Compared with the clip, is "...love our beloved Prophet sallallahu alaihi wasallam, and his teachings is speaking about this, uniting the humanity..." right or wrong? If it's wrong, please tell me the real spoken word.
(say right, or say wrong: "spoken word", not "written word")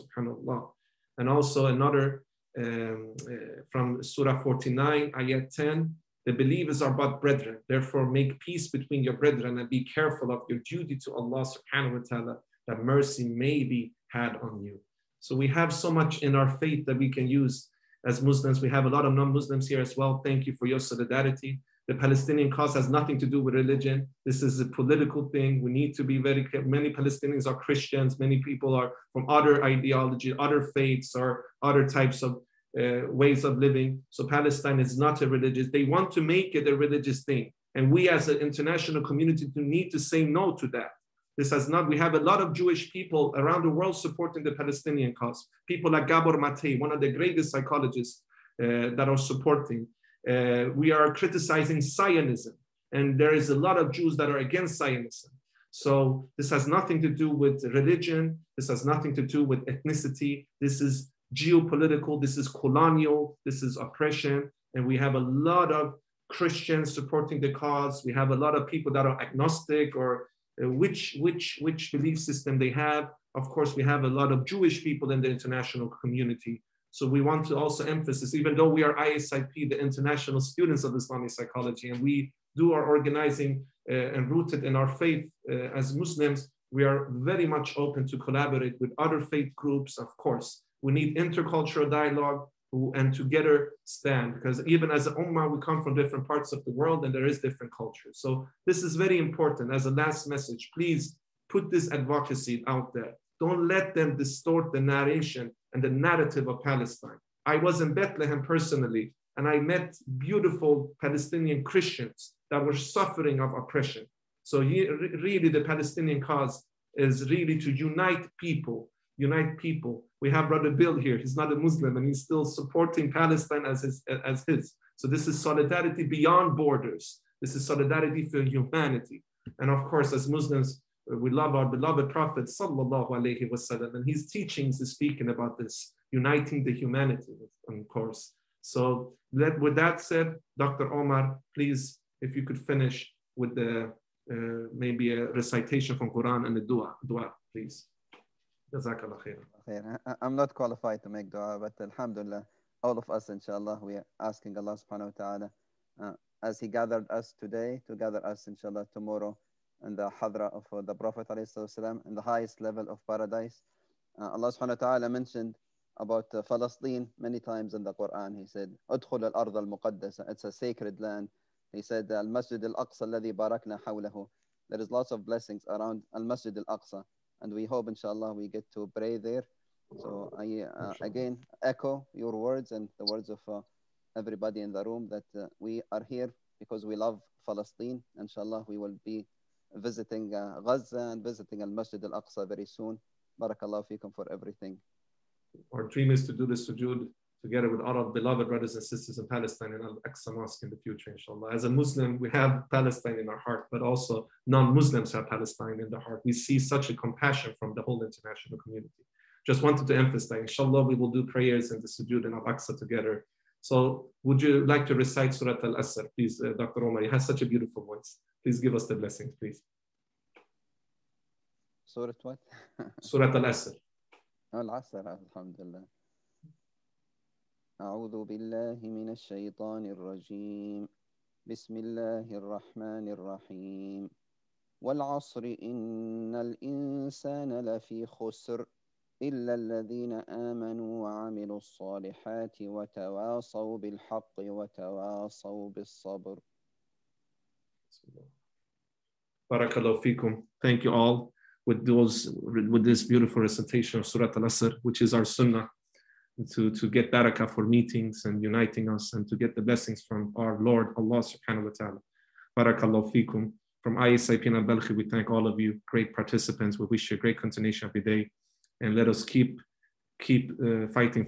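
right.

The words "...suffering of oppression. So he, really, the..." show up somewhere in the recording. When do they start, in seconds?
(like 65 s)
112 s.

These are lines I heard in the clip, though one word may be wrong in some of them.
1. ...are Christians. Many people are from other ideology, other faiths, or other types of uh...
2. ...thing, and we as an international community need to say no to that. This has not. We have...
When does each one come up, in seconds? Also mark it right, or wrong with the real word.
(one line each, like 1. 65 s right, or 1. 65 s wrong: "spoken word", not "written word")
1. 27 s right
2. 37 s right.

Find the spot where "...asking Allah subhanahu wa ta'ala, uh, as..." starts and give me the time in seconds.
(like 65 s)
154 s.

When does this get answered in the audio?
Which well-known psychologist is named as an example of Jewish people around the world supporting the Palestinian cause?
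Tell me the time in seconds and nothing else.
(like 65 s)
46 s.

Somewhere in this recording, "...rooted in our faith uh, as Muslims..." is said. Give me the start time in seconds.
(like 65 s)
84 s.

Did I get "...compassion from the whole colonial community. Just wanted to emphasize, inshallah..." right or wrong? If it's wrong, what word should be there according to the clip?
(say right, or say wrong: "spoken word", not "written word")
wrong: "international", not "colonial".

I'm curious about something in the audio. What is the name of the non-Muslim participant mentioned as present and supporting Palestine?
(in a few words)
Bill.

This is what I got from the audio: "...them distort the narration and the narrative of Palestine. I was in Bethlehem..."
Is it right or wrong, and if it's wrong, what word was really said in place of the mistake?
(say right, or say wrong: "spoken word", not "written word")
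right.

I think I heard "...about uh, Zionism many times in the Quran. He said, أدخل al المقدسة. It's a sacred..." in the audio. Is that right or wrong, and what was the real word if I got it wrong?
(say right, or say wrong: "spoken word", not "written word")
wrong: "Palestine", not "Zionism".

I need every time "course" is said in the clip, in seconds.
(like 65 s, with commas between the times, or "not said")
73 s, 90 s, 129 s, 137 s.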